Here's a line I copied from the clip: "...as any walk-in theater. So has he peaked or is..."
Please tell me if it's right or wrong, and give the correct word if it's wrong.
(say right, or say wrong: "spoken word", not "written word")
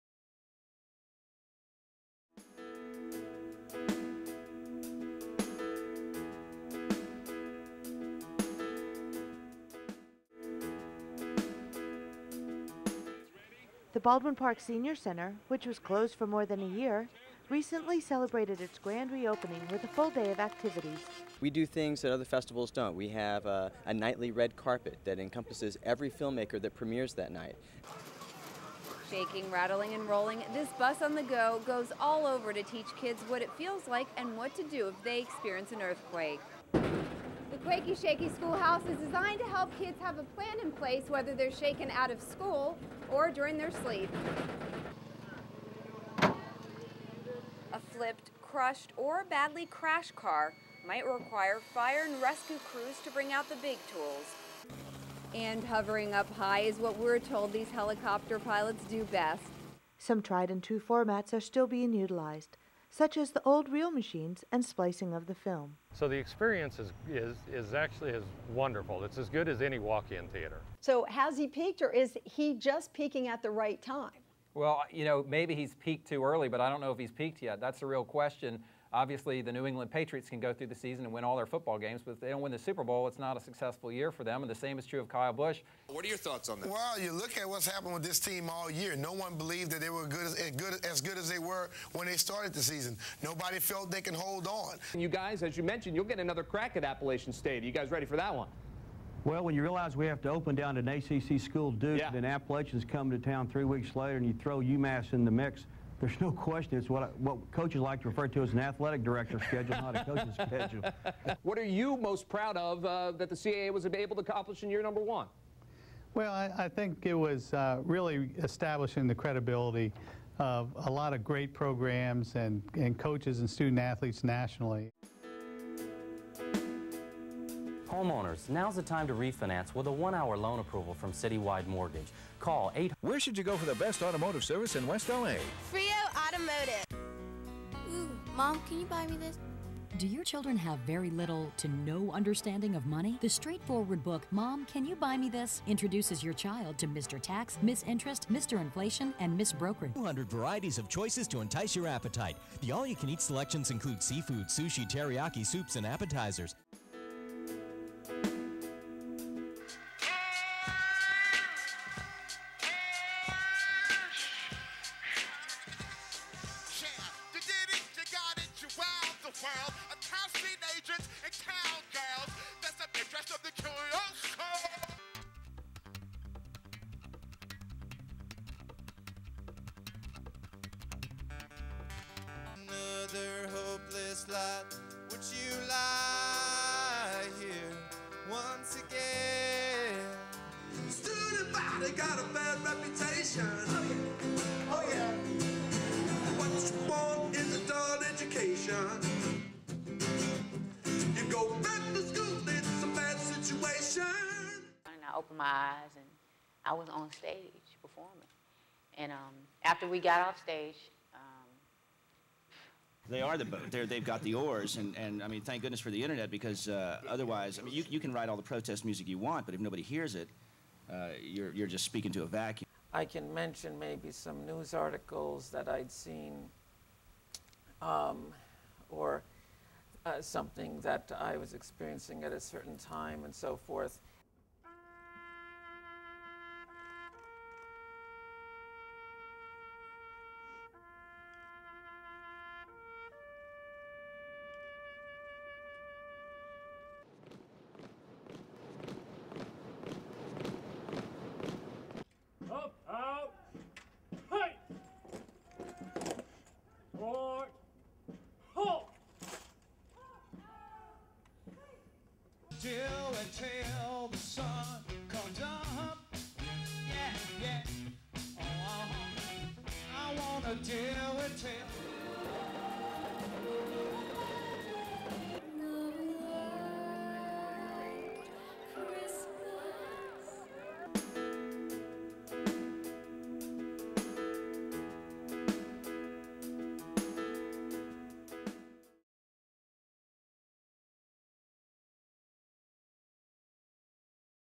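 right.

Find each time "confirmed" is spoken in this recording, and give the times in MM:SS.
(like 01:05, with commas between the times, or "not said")
not said.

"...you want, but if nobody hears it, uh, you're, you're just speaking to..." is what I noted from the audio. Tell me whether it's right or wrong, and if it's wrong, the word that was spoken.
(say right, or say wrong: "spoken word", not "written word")
right.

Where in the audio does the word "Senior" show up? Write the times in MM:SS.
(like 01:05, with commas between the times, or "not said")
00:14.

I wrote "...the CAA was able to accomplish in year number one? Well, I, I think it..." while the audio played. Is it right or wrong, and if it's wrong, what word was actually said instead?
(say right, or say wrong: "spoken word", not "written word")
right.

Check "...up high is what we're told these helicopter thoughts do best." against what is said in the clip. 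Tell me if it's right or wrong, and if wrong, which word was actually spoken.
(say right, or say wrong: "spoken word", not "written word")
wrong: "pilots", not "thoughts".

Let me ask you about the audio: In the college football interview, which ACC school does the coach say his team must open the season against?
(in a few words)
Duke.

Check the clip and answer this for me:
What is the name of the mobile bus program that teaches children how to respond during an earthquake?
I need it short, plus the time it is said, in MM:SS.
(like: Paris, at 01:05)
Quakey, Shaky Schoolhouse, at 00:37.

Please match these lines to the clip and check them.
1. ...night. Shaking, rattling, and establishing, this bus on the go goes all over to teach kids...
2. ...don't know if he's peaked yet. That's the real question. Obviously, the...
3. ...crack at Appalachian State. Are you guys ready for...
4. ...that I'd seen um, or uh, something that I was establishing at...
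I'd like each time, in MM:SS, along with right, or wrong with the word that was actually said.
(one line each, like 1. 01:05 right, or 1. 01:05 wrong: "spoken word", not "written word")
1. 00:27 wrong: "rolling", not "establishing"
2. 01:16 right
3. 01:36 right
4. 03:45 wrong: "experiencing", not "establishing".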